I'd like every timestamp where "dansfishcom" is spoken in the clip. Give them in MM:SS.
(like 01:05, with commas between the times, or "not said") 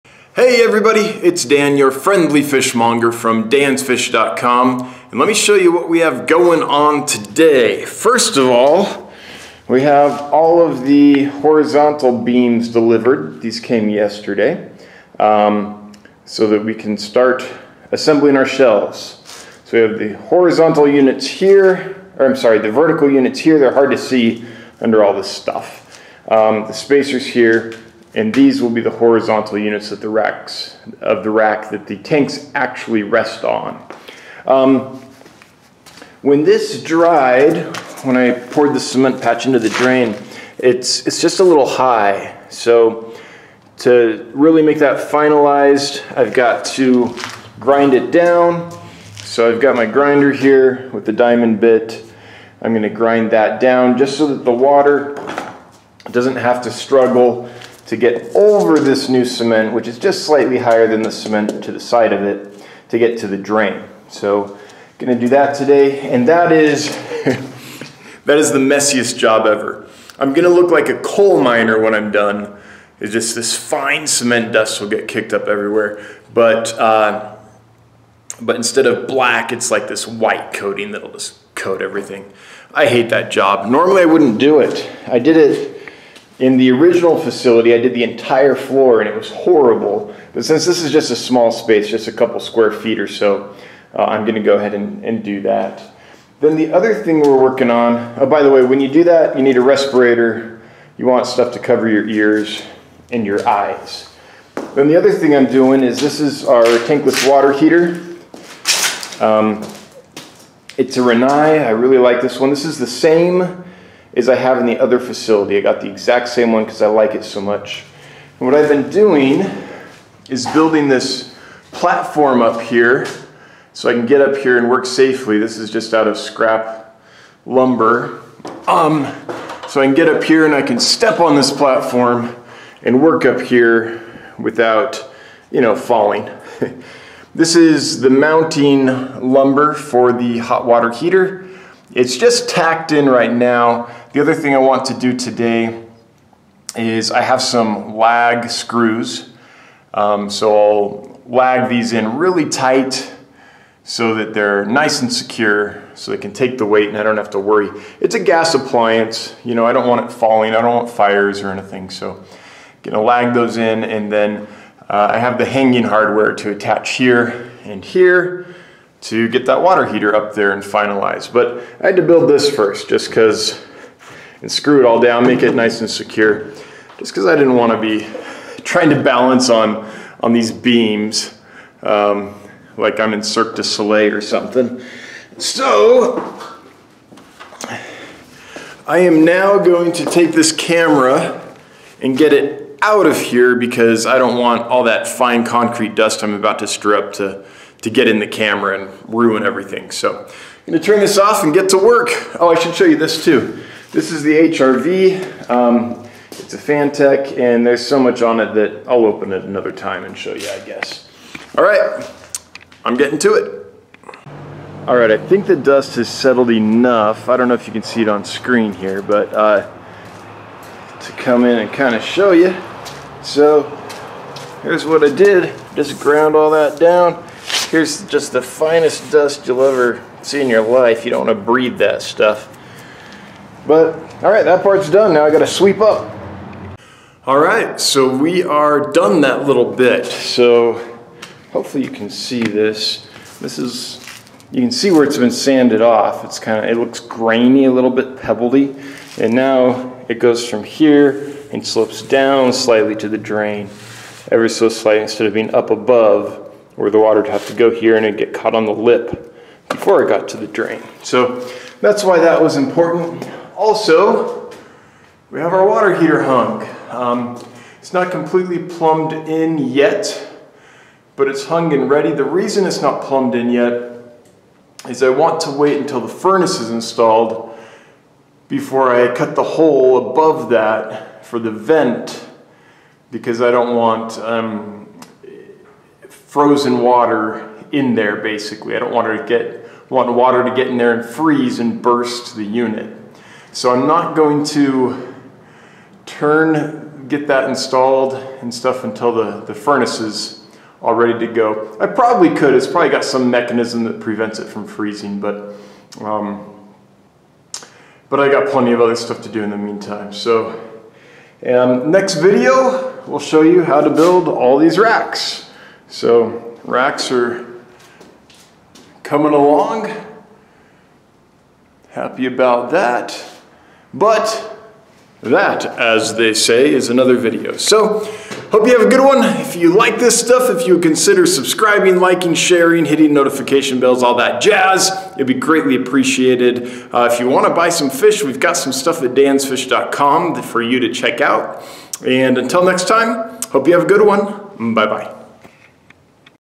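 00:03, 05:39.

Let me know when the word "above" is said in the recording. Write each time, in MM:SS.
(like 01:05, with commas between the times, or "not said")
04:15, 04:40.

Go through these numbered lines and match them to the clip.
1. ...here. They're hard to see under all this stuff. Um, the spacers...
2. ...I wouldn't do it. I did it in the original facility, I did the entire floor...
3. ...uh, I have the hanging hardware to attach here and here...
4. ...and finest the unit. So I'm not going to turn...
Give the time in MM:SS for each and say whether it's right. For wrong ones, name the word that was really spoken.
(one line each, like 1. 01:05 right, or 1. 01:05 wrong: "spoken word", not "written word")
1. 00:23 right
2. 01:24 right
3. 02:44 right
4. 04:51 wrong: "burst", not "finest".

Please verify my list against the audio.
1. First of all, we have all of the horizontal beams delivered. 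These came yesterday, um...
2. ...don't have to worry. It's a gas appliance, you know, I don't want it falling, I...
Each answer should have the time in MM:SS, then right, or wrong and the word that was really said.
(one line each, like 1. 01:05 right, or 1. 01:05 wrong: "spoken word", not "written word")
1. 00:07 right
2. 02:37 right.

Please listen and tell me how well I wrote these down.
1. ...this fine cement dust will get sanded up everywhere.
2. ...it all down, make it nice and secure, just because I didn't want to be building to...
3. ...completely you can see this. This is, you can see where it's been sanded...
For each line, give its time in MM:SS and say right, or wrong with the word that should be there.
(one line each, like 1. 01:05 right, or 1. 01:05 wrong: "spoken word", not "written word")
1. 01:13 wrong: "kicked", not "sanded"
2. 02:54 wrong: "trying", not "building"
3. 04:01 wrong: "hopefully", not "completely".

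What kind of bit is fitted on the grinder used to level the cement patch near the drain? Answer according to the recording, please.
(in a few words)
diamond bit.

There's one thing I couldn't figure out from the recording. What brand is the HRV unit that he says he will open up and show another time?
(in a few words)
Fantech.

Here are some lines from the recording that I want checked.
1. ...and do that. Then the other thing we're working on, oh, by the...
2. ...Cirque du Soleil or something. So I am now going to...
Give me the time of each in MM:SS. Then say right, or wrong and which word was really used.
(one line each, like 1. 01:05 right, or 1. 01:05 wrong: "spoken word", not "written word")
1. 01:35 right
2. 03:03 right.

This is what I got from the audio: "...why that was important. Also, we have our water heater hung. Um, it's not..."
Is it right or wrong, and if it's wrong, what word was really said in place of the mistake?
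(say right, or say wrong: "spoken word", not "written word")
right.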